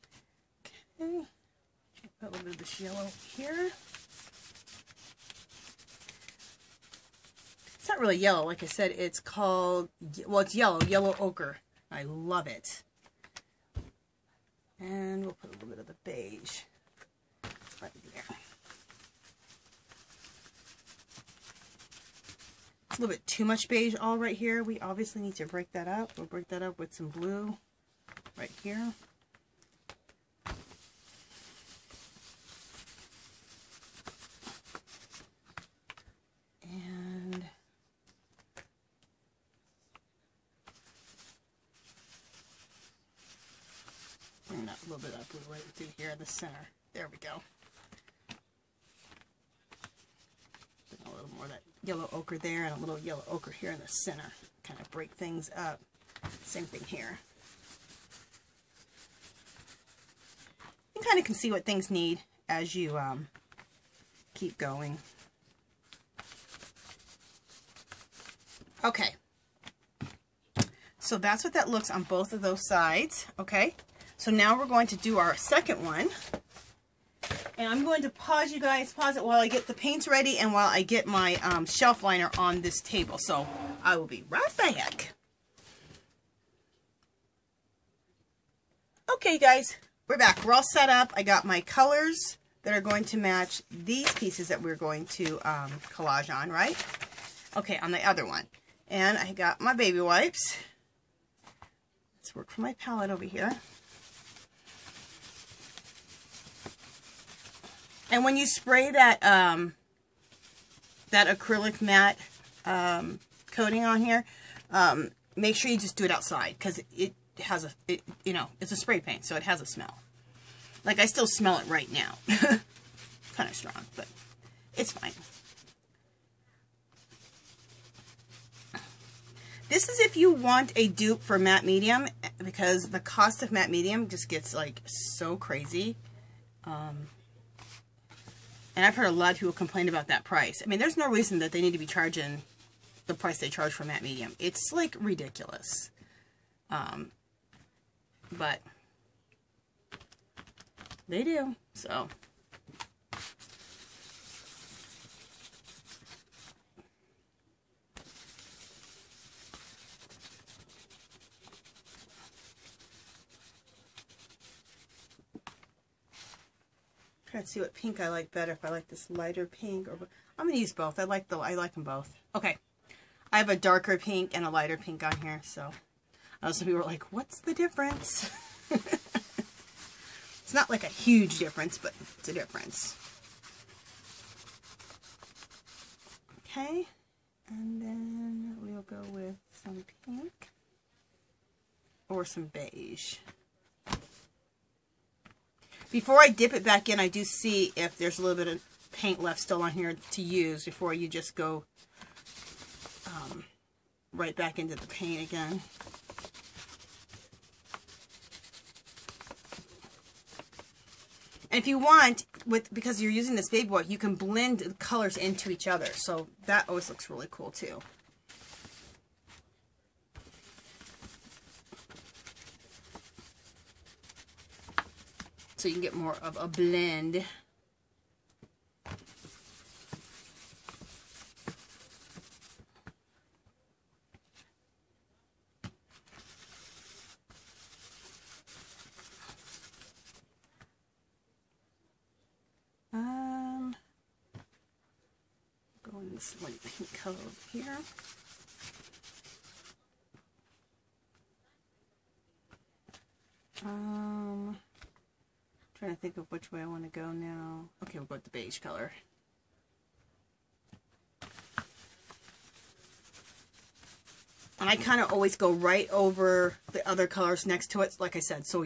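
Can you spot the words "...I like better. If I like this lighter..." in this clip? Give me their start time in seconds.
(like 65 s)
168 s.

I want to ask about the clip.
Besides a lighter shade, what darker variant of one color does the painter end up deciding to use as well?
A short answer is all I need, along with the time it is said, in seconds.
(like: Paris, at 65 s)
Darker pink, at 173 s.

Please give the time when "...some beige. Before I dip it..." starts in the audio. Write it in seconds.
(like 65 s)
192 s.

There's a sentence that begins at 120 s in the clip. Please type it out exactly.
Like I still smell it right now.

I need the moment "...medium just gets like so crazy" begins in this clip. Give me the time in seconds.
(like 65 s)
133 s.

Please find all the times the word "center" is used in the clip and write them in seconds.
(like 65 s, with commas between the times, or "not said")
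46 s, 53 s.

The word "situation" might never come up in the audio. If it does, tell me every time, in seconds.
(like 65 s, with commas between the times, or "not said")
not said.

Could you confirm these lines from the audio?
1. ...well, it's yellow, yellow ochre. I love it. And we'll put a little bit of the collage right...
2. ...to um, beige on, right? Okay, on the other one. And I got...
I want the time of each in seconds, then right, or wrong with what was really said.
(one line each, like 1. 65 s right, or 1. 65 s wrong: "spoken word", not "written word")
1. 10 s wrong: "beige", not "collage"
2. 95 s wrong: "collage", not "beige".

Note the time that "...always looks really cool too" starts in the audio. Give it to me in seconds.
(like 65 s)
216 s.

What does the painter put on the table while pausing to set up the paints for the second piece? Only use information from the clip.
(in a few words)
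Shelf liner.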